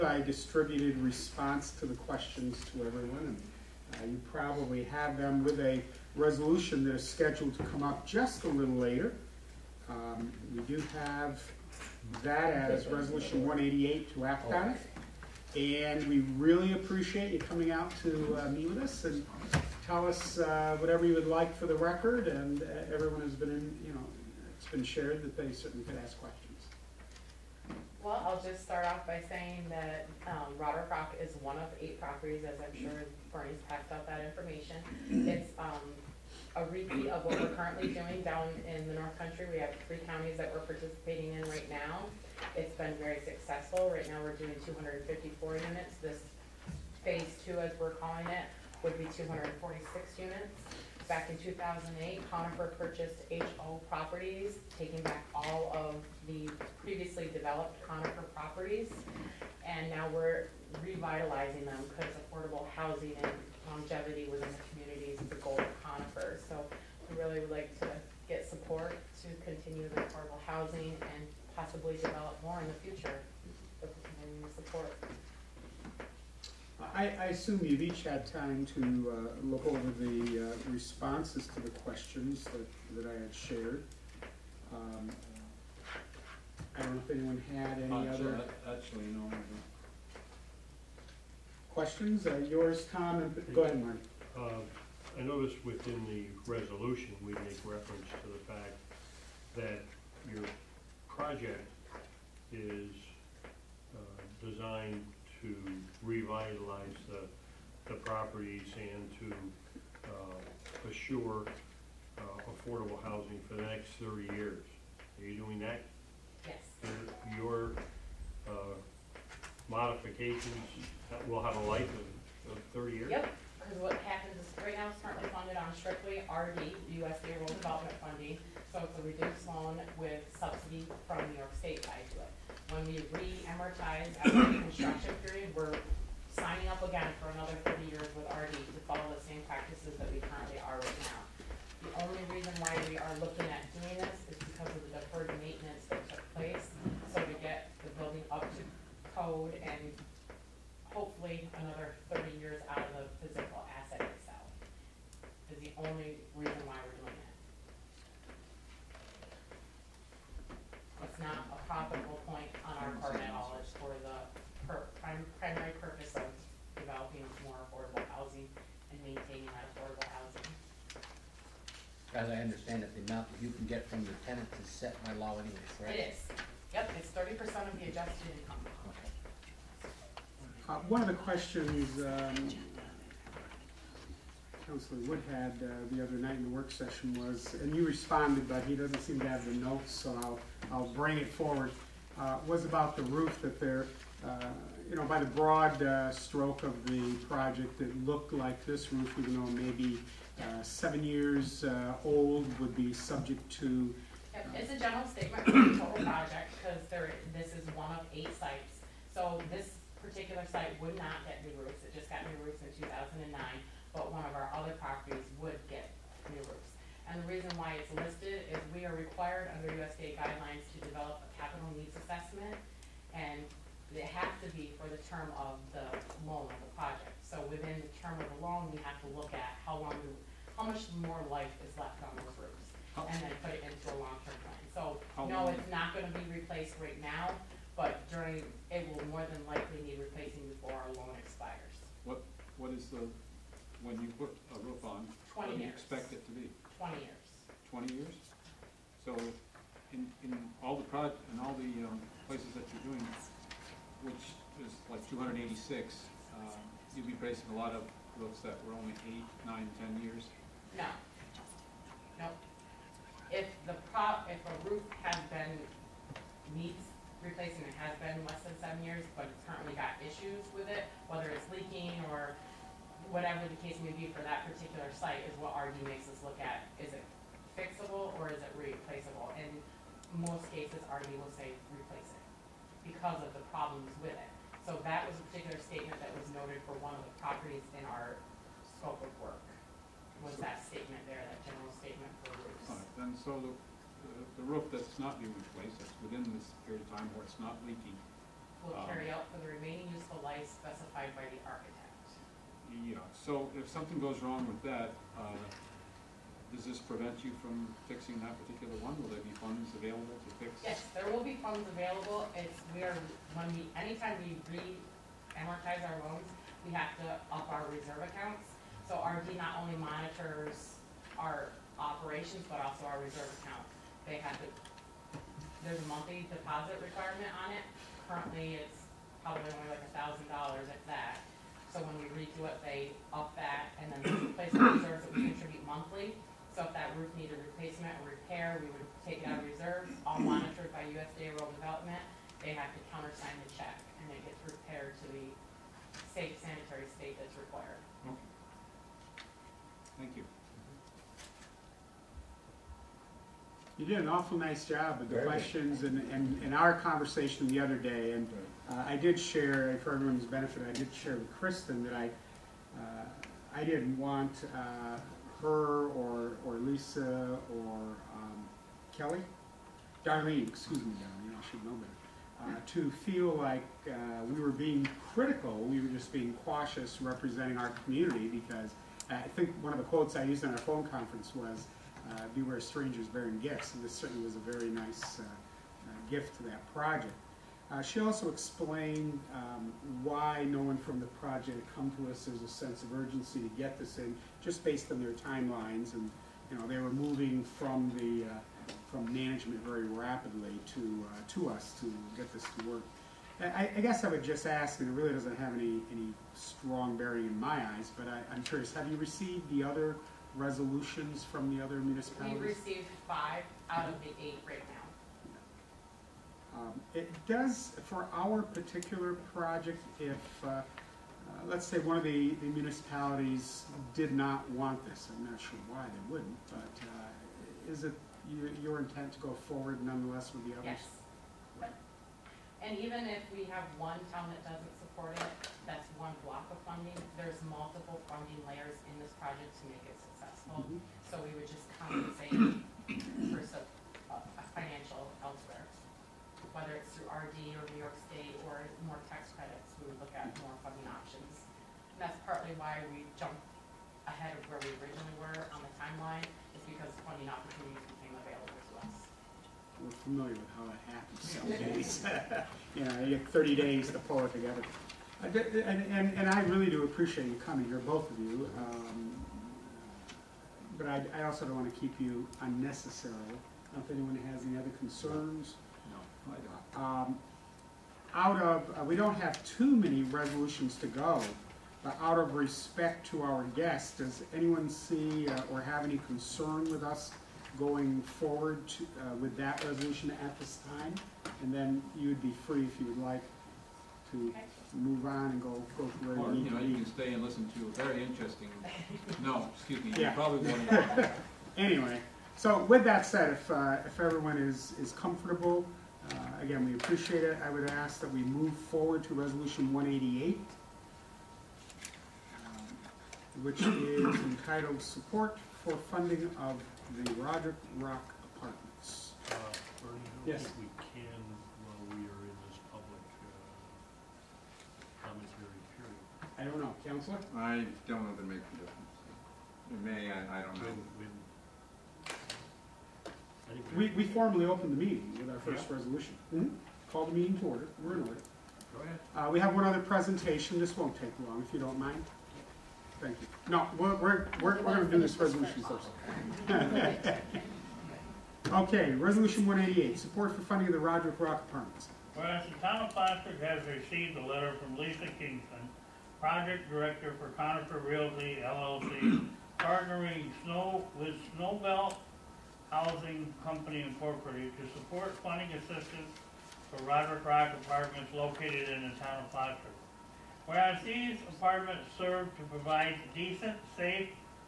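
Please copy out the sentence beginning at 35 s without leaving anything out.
It's um, a repeat of what we're currently doing down in the North Country.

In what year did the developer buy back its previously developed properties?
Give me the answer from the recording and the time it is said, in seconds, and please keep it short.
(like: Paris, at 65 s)
2008, at 51 s.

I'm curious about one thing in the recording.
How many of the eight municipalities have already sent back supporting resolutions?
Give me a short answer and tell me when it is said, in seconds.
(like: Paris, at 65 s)
5, at 413 s.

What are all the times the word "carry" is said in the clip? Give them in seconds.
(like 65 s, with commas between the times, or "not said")
298 s.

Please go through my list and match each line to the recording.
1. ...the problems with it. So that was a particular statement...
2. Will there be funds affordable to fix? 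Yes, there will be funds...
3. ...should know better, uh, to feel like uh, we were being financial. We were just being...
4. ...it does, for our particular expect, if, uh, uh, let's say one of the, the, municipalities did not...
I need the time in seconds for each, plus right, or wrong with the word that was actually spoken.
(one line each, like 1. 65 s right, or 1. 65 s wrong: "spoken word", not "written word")
1. 283 s right
2. 309 s wrong: "available", not "affordable"
3. 371 s wrong: "critical", not "financial"
4. 416 s wrong: "project", not "expect".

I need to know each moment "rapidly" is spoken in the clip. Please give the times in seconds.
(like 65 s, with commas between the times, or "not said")
399 s.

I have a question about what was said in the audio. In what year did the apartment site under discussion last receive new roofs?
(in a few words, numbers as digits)
2009.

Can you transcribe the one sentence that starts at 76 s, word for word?
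I, I, assume you've each had time to uh, look over the uh, responses to the questions that, that I had shared.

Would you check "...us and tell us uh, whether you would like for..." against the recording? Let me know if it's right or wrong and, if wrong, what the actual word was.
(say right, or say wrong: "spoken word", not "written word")
wrong: "whatever", not "whether".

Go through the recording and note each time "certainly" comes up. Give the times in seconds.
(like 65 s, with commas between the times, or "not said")
25 s, 383 s.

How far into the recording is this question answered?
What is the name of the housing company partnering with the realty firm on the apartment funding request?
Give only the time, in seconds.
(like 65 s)
561 s.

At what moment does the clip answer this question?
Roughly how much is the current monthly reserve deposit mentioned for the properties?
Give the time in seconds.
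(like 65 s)
329 s.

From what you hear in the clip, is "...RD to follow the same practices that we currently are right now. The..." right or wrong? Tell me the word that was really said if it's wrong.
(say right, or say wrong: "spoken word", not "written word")
right.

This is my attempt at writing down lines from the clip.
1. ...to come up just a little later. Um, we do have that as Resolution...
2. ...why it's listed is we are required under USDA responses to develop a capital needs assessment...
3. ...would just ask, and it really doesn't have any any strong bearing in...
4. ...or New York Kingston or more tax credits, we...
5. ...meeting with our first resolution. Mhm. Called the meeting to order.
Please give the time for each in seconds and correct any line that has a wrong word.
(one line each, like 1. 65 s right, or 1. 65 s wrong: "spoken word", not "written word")
1. 7 s right
2. 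217 s wrong: "guidelines", not "responses"
3. 404 s right
4. 447 s wrong: "State", not "Kingston"
5. 534 s right.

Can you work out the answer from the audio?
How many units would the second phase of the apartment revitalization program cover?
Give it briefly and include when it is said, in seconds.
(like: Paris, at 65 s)
246, at 49 s.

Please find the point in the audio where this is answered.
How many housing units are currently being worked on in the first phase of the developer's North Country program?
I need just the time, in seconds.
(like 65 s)
44 s.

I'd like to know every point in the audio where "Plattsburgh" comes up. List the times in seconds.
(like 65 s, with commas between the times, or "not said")
552 s, 569 s.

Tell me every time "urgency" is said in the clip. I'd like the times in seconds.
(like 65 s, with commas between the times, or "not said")
392 s.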